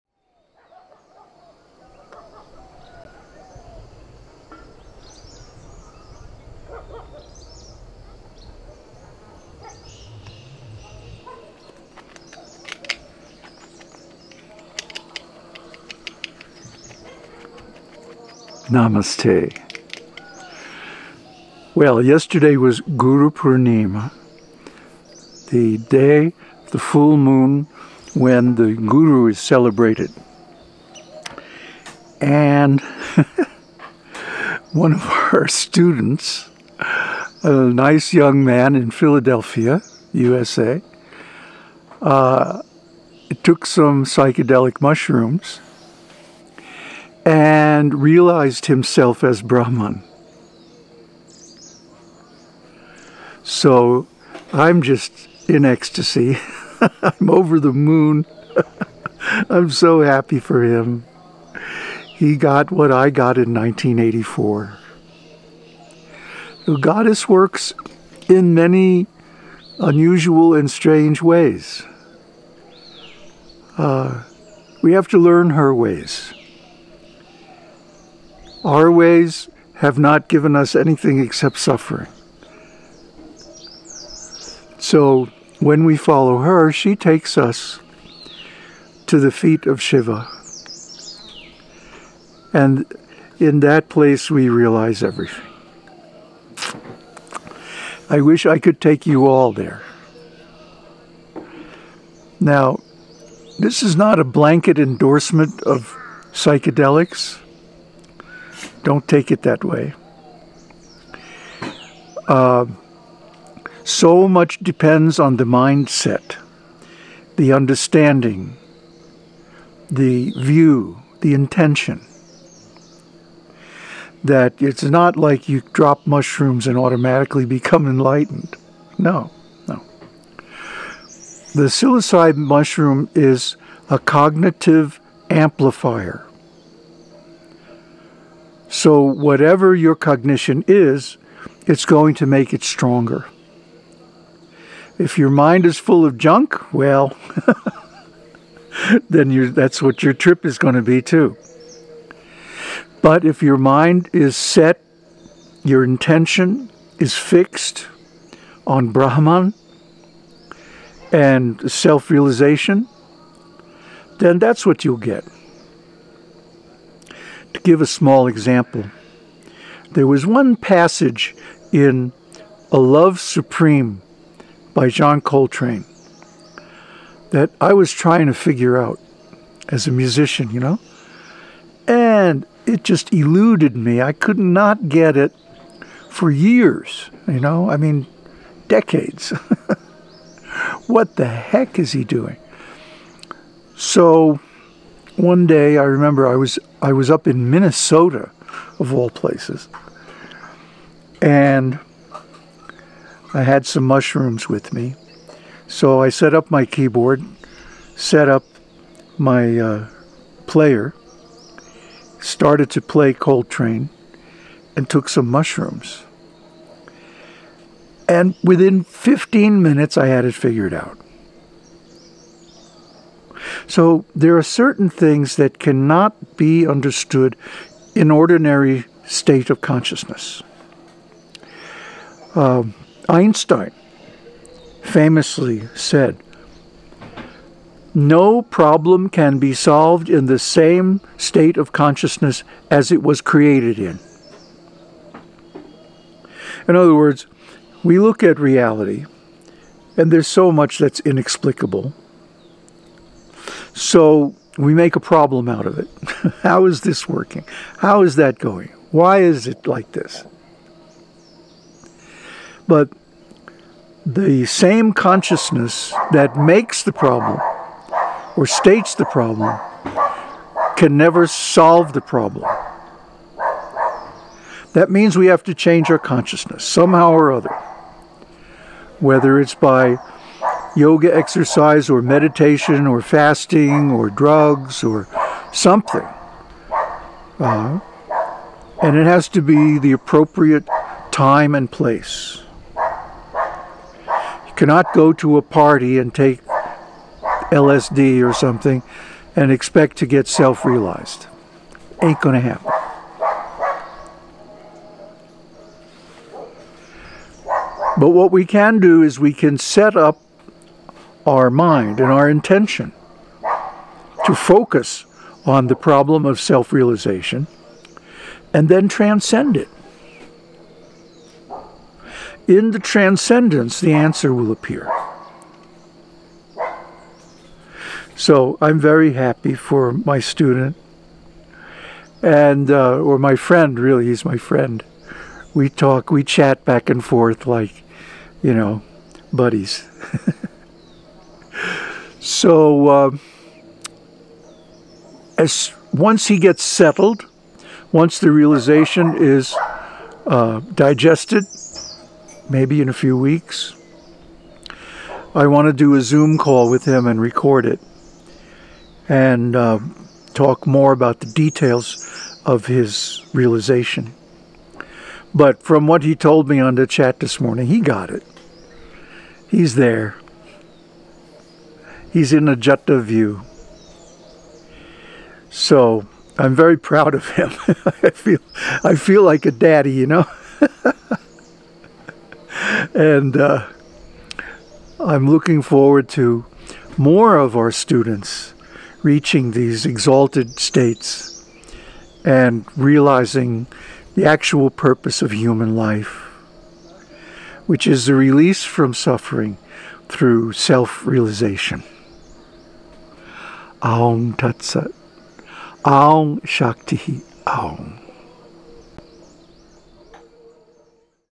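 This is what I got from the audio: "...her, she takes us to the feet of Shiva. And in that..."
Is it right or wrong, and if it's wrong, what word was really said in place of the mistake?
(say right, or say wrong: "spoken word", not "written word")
right.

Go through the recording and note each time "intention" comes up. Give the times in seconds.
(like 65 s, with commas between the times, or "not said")
121 s, 155 s, 312 s.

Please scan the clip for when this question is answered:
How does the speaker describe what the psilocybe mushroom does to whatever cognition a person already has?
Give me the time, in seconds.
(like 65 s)
133 s.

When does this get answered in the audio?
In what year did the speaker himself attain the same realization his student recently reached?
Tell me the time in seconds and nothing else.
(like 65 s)
63 s.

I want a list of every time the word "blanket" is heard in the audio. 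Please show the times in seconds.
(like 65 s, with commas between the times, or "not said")
104 s.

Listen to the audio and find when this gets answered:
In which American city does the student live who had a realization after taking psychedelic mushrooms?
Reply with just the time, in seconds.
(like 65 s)
38 s.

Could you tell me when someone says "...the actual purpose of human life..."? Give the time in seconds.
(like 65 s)
394 s.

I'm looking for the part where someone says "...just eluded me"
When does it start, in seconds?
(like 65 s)
182 s.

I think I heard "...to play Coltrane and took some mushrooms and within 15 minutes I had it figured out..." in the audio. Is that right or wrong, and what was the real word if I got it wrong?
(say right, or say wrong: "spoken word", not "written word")
right.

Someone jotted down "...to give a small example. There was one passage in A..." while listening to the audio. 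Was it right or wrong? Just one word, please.
right.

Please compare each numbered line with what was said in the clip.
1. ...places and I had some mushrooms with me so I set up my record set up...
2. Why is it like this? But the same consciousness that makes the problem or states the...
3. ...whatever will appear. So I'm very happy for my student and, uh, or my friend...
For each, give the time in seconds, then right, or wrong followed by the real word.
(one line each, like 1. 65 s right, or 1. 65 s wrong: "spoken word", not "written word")
1. 199 s wrong: "keyboard", not "record"
2. 258 s right
3. 323 s wrong: "answer", not "whatever".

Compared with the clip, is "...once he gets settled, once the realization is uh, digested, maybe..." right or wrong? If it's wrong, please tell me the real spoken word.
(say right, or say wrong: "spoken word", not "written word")
right.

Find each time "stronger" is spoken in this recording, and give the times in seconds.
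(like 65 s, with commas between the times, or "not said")
142 s.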